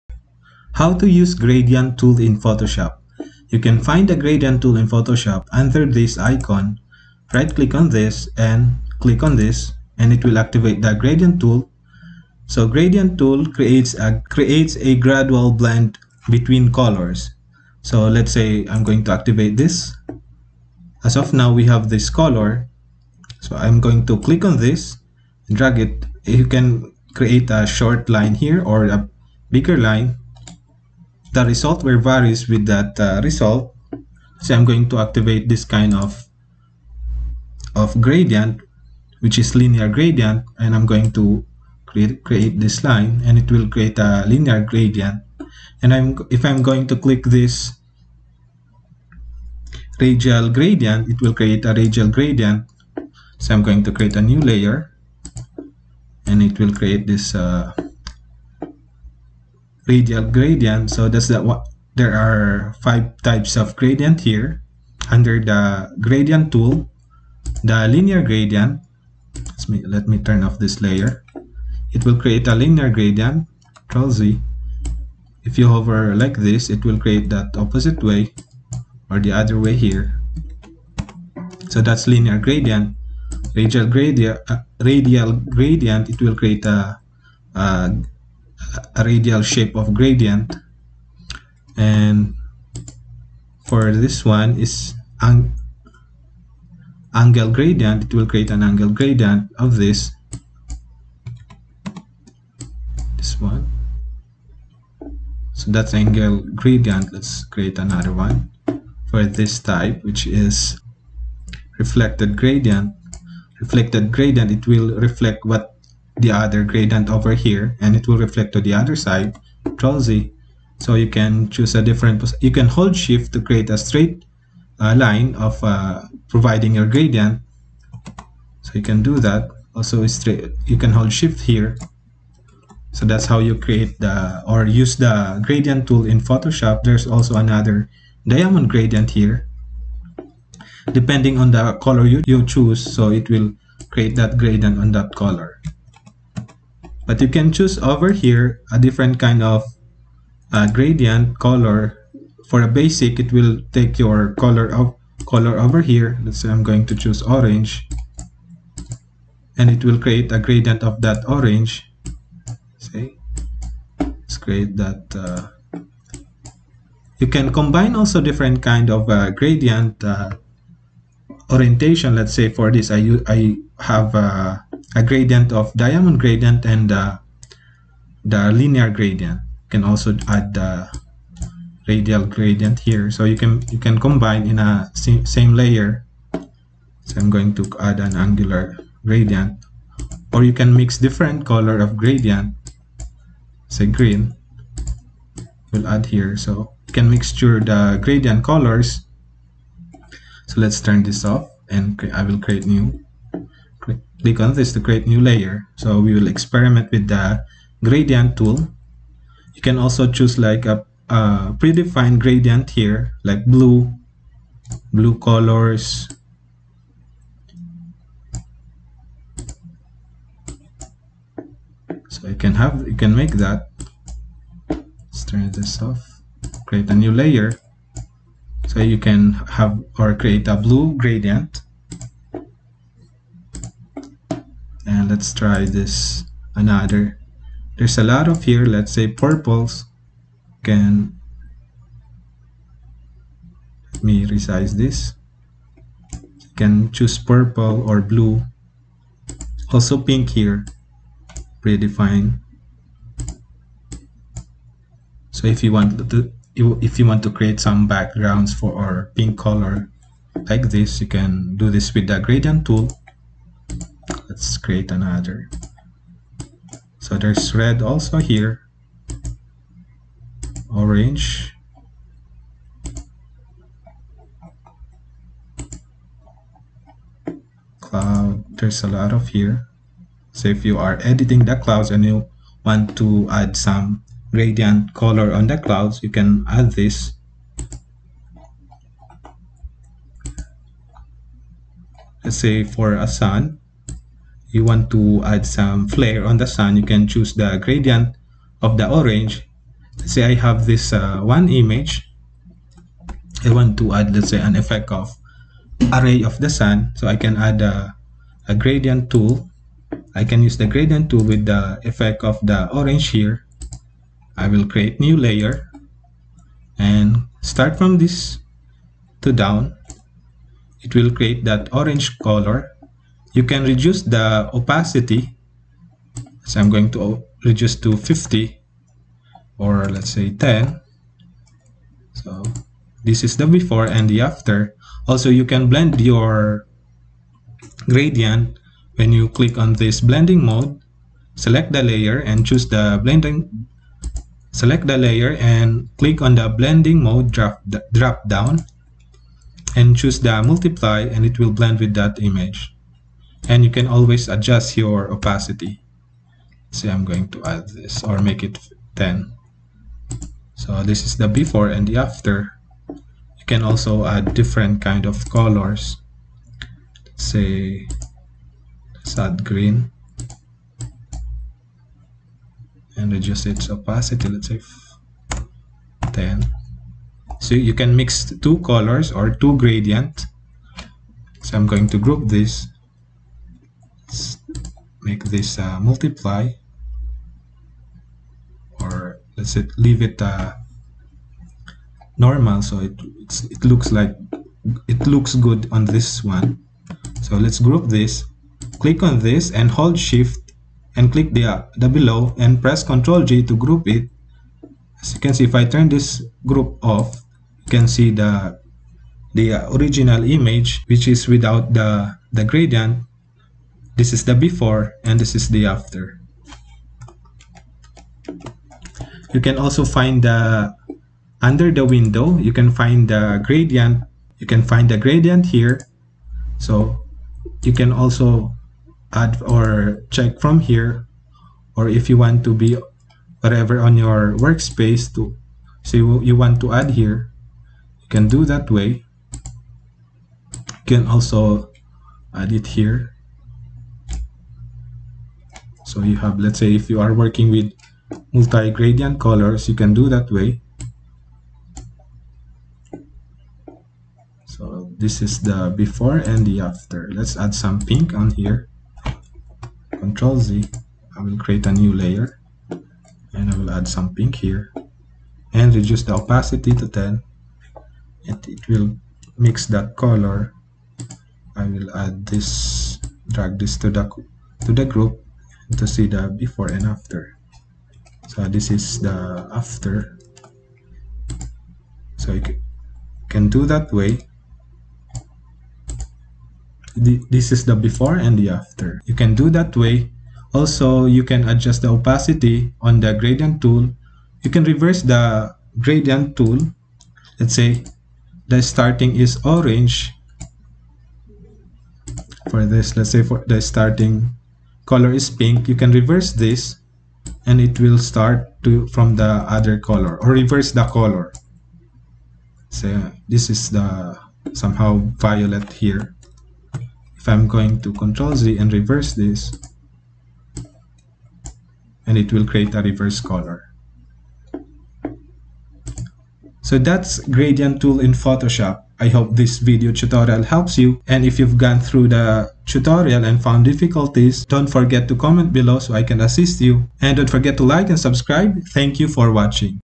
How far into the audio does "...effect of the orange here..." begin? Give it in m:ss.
5:11.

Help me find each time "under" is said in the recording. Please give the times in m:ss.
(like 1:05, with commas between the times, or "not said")
0:05, 1:05, 7:01.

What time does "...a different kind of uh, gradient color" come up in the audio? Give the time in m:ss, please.
2:28.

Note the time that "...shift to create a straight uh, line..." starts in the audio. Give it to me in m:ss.
2:02.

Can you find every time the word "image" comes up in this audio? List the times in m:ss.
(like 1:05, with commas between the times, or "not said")
5:01, 5:52, 6:50.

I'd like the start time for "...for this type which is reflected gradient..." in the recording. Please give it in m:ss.
1:49.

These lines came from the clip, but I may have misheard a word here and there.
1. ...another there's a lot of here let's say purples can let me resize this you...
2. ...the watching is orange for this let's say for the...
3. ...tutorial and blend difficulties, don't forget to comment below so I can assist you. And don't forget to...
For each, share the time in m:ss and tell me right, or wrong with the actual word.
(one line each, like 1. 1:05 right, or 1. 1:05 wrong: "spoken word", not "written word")
1. 3:56 right
2. 8:18 wrong: "starting", not "watching"
3. 8:52 wrong: "found", not "blend".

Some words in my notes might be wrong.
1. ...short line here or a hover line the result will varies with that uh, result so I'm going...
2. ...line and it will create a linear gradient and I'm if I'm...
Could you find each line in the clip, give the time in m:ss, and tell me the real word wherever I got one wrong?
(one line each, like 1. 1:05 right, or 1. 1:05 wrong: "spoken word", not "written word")
1. 0:27 wrong: "bigger", not "hover"
2. 0:42 right.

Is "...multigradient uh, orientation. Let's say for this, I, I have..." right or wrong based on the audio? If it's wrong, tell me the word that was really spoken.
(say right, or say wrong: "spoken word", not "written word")
wrong: "gradient", not "multigradient".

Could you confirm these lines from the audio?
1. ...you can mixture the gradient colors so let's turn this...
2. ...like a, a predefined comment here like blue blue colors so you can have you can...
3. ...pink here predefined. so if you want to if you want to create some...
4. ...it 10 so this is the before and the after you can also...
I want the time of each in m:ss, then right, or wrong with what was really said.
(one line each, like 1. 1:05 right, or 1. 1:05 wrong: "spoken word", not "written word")
1. 3:16 right
2. 3:30 wrong: "gradient", not "comment"
3. 4:09 right
4. 5:58 right.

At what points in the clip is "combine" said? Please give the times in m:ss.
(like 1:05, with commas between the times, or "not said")
2:47, 3:03.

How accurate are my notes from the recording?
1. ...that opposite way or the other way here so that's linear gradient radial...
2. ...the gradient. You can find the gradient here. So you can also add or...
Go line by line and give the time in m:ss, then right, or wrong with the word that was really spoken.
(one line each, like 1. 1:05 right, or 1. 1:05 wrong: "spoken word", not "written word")
1. 1:17 right
2. 7:03 right.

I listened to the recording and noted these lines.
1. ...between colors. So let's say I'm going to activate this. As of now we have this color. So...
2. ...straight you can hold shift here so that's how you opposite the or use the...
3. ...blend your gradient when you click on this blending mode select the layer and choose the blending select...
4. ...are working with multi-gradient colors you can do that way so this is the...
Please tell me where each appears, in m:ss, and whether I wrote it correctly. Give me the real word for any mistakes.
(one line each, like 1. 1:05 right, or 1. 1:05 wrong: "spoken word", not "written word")
1. 0:16 right
2. 2:10 wrong: "create", not "opposite"
3. 5:35 right
4. 7:27 right.